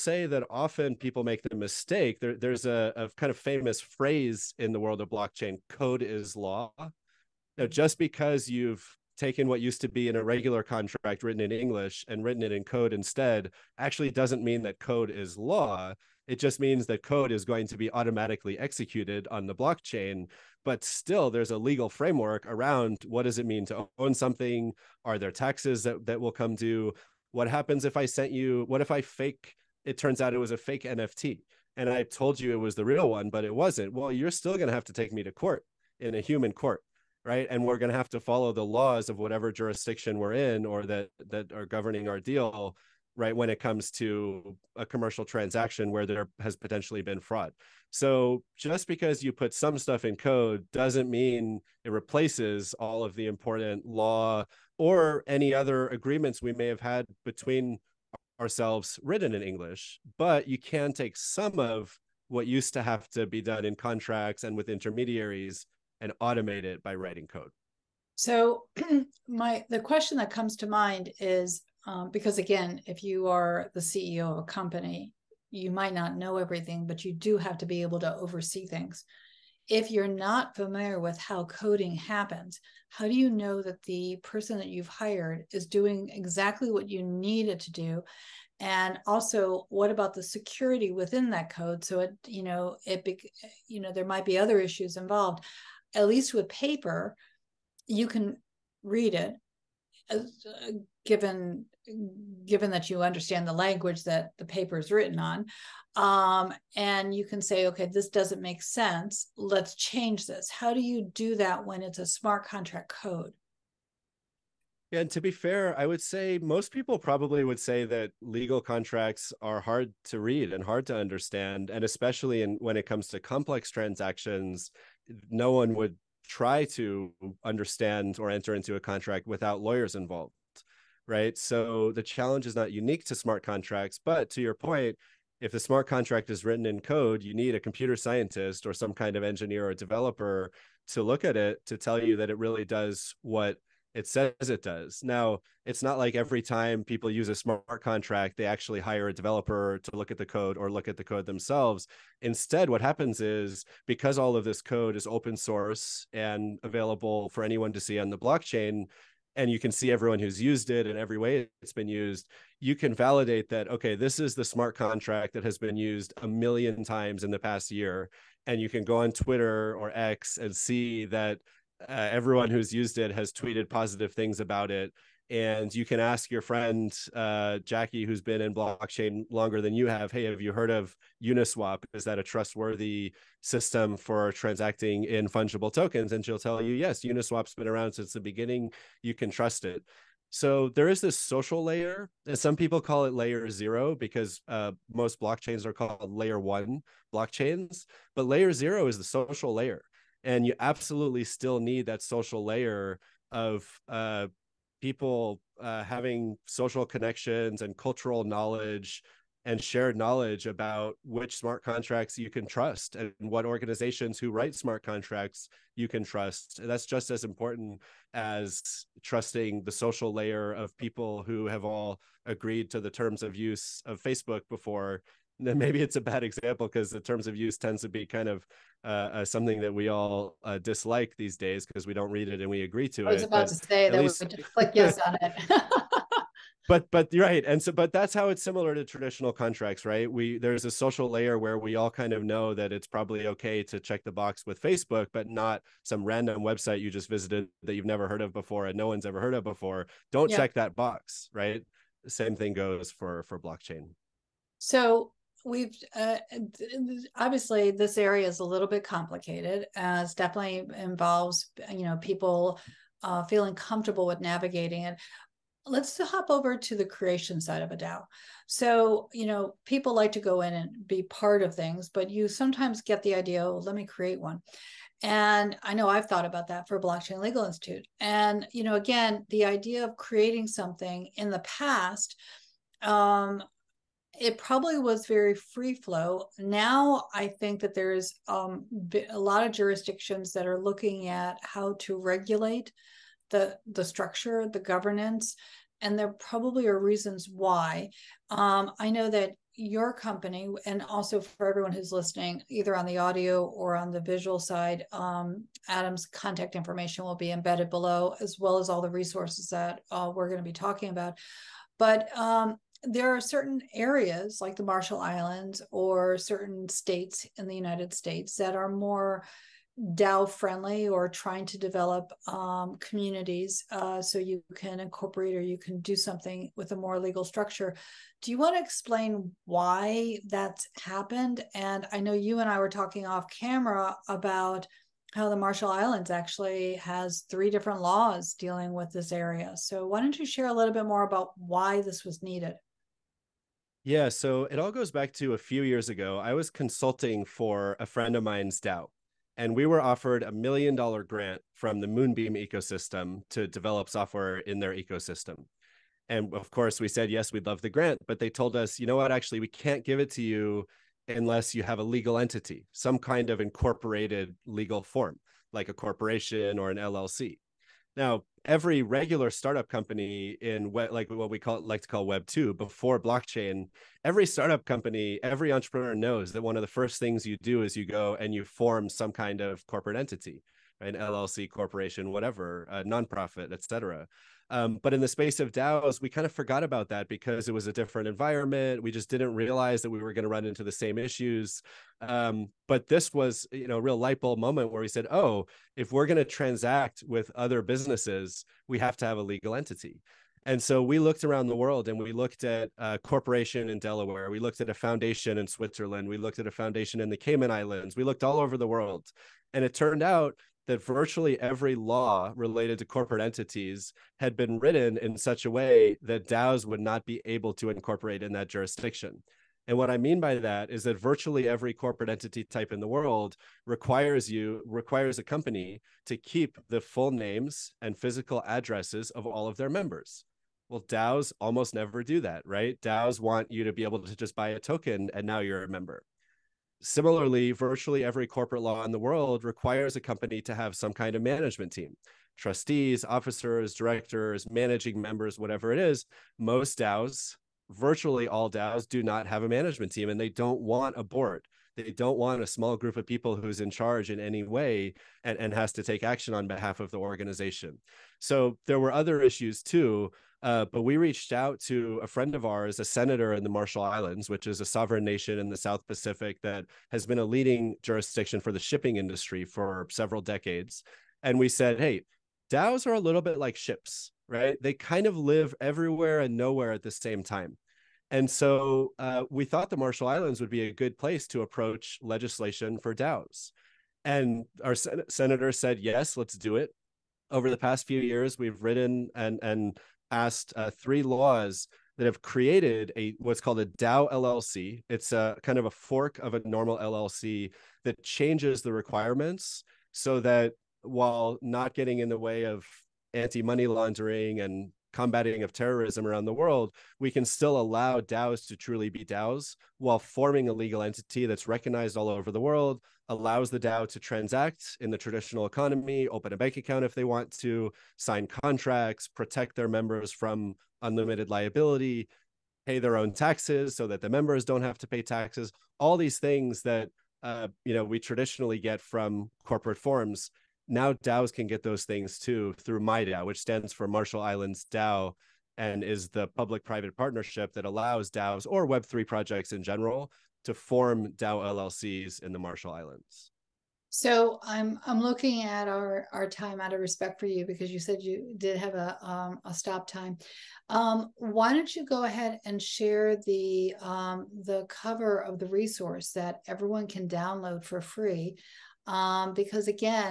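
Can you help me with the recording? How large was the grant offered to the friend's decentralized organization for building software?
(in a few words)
$1 million.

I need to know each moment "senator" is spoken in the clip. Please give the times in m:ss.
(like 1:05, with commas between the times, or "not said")
7:42, 8:05.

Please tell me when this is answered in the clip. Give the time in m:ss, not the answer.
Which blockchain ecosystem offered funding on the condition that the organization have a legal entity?
5:51.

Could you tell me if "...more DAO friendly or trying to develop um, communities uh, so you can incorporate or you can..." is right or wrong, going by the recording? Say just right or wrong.
right.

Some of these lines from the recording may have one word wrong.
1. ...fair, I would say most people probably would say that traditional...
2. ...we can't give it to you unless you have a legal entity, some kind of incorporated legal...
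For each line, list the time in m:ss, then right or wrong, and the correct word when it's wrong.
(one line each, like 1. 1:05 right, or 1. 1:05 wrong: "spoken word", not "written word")
1. 1:55 wrong: "legal", not "traditional"
2. 5:59 right.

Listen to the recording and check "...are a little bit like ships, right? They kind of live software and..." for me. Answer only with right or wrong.
wrong.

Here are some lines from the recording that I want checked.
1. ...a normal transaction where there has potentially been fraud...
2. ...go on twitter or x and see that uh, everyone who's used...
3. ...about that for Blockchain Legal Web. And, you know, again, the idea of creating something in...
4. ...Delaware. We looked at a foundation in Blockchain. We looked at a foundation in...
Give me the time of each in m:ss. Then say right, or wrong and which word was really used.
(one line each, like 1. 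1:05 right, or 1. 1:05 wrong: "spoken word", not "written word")
1. 0:44 wrong: "commercial", not "normal"
2. 2:48 right
3. 4:36 wrong: "Institute", not "Web"
4. 6:43 wrong: "Switzerland", not "Blockchain".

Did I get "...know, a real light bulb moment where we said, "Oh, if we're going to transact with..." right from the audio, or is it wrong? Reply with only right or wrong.
right.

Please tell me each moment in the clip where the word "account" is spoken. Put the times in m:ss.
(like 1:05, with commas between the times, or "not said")
8:36.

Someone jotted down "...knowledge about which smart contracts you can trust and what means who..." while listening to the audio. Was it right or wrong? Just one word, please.
wrong.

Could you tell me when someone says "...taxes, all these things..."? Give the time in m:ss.
8:45.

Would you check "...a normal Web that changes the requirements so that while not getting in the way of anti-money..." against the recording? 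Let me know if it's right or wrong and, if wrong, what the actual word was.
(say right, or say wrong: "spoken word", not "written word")
wrong: "LLC", not "Web".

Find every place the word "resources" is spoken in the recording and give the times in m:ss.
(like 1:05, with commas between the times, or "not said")
5:08, 9:15.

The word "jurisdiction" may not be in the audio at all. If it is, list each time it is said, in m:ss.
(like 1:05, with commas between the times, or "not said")
0:39, 4:49, 6:58, 7:47.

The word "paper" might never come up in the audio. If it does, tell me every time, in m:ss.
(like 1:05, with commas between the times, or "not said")
1:36, 1:44.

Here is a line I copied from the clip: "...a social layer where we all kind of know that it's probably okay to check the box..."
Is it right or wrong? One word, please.
right.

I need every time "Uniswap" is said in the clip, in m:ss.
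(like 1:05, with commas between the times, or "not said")
3:01, 3:07.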